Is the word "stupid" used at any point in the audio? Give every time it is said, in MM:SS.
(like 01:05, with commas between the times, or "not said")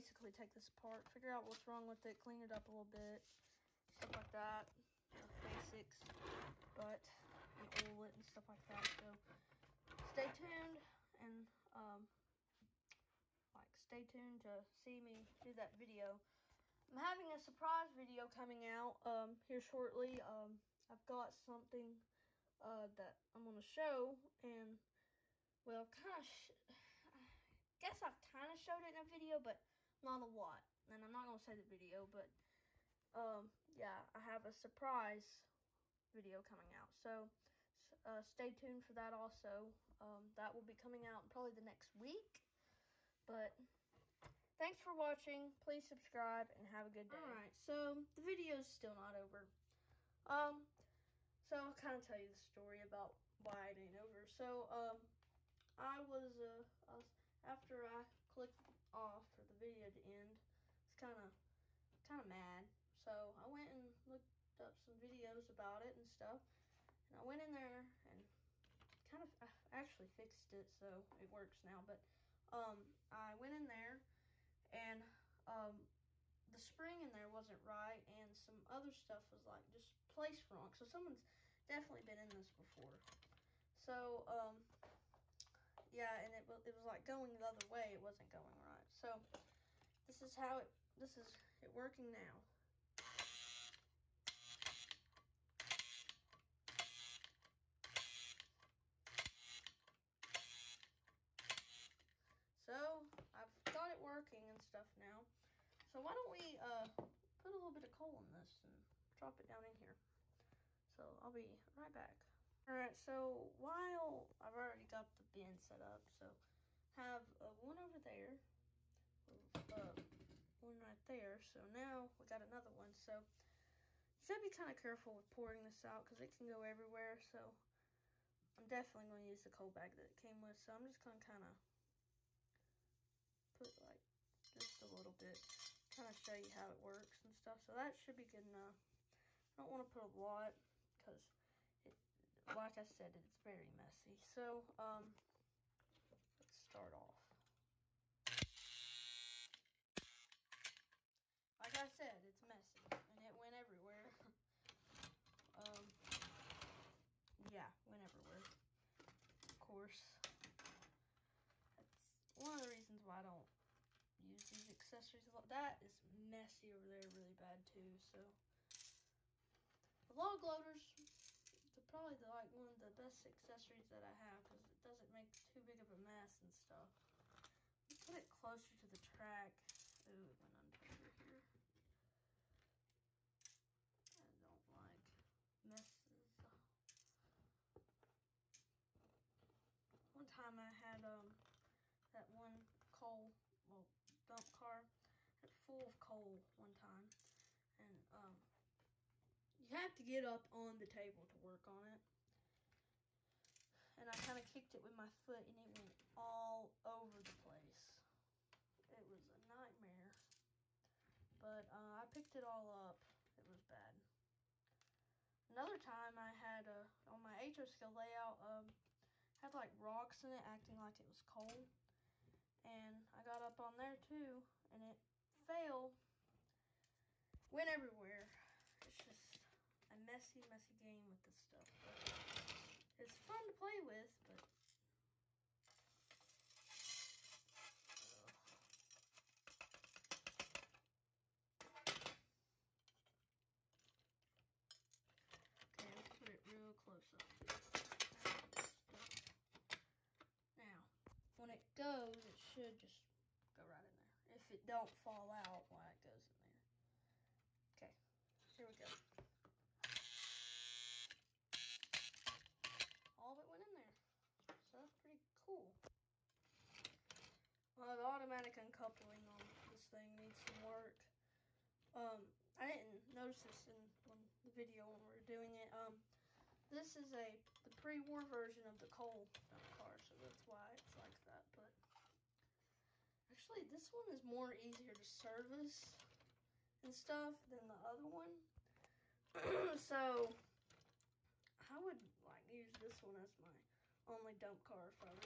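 not said.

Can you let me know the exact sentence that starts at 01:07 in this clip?
And I went in there and kind of I actually fixed it so it works now.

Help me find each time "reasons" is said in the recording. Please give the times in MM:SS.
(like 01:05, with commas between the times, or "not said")
02:42.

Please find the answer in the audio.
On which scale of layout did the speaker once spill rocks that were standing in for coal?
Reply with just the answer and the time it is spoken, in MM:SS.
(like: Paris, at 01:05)
HO scale, at 03:37.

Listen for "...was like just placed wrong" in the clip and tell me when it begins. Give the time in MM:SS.
01:19.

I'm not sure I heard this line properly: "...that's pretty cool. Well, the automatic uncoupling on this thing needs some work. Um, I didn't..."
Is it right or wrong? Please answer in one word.
right.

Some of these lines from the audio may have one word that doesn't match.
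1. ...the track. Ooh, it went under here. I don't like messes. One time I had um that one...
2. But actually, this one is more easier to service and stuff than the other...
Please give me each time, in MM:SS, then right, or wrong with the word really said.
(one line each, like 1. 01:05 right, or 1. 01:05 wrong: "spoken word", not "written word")
1. 02:58 right
2. 04:41 right.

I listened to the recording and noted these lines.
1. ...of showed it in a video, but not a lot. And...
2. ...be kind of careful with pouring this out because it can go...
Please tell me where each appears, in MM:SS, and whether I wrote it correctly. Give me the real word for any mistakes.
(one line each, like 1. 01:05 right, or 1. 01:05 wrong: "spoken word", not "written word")
1. 00:28 right
2. 02:04 right.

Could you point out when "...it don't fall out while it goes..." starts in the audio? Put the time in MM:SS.
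04:14.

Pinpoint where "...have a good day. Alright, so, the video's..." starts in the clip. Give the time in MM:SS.
00:46.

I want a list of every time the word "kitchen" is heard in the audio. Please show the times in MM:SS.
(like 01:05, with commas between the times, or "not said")
not said.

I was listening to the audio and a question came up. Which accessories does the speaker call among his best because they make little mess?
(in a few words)
log loaders.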